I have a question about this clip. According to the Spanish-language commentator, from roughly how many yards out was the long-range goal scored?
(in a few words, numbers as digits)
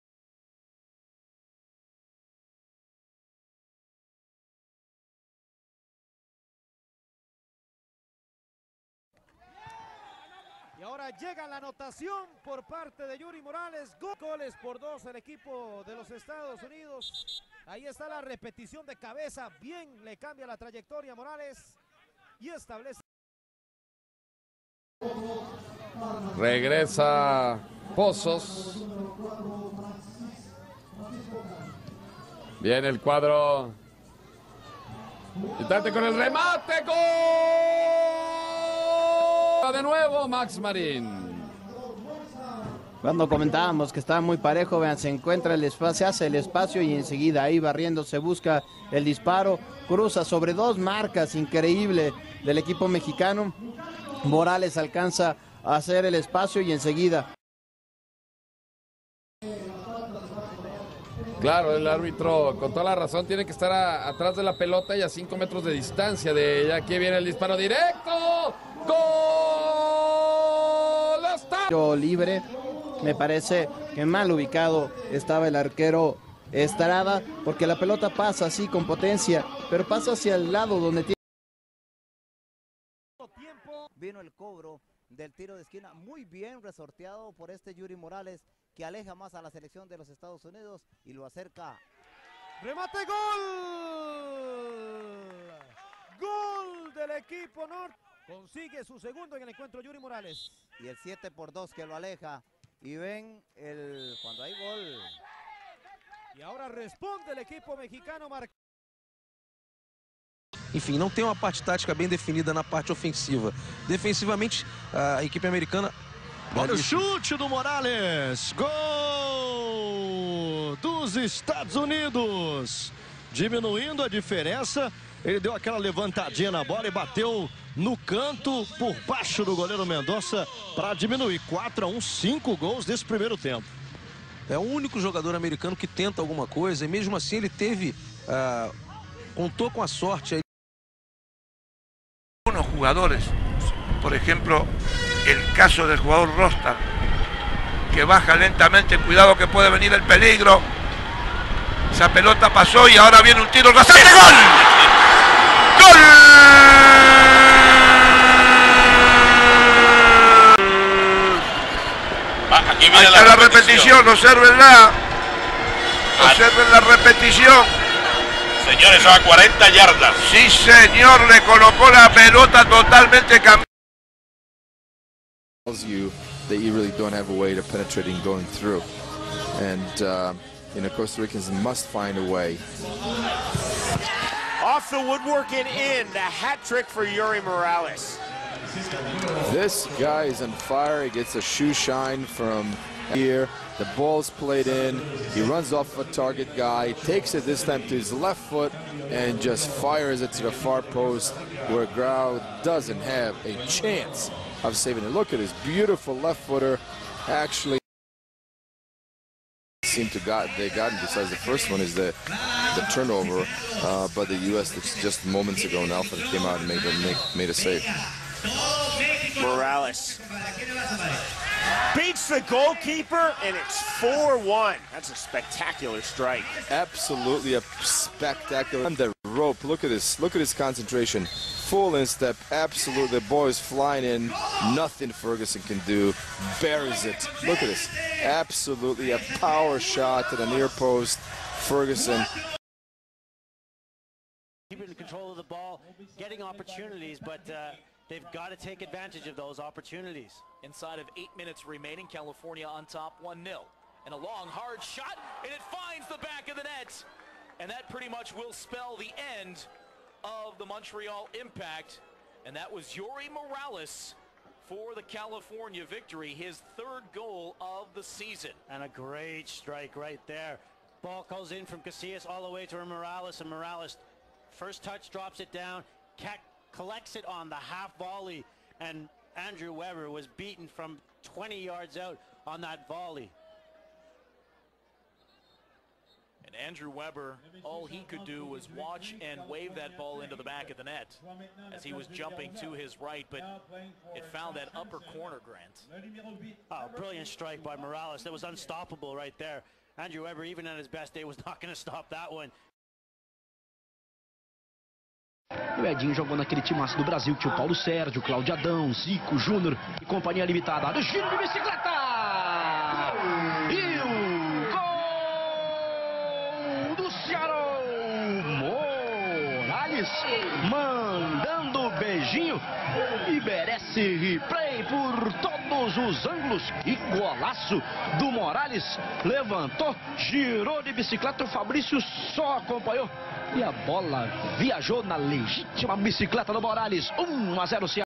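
40 yards.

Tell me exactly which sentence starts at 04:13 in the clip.
And a long, hard shot, and it finds the back of the net.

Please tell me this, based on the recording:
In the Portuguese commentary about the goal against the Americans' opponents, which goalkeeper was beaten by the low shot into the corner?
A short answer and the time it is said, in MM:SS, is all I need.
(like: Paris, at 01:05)
Mendonça, at 02:09.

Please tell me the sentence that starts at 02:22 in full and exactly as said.
Alguns jogadores, por exemplo, o caso do jogador Rostar, que baja lentamente, cuidado que pode venir o peligro.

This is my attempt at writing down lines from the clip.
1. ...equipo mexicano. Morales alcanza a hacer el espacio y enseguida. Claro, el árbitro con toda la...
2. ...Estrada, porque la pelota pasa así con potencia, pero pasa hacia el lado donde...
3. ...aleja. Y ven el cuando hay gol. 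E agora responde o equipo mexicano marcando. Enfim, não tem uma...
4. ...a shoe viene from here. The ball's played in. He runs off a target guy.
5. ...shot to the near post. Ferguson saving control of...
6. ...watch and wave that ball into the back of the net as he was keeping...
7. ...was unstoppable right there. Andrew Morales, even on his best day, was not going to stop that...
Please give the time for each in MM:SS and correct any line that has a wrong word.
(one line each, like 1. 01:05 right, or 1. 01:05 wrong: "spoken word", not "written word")
1. 00:52 right
2. 01:16 right
3. 01:41 right
4. 03:11 wrong: "shine", not "viene"
5. 03:59 wrong: "keeping", not "saving"
6. 04:48 wrong: "jumping", not "keeping"
7. 04:58 wrong: "Weber", not "Morales".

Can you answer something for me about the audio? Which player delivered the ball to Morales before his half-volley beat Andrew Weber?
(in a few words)
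Casillas.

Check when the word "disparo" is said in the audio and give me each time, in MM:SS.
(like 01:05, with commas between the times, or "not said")
00:49, 01:07.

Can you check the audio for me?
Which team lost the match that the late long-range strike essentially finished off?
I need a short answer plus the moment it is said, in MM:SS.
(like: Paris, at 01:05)
Montreal Impact, at 04:20.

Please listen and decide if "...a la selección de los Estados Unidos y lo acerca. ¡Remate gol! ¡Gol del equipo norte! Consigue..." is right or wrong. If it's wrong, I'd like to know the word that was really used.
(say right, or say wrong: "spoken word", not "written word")
right.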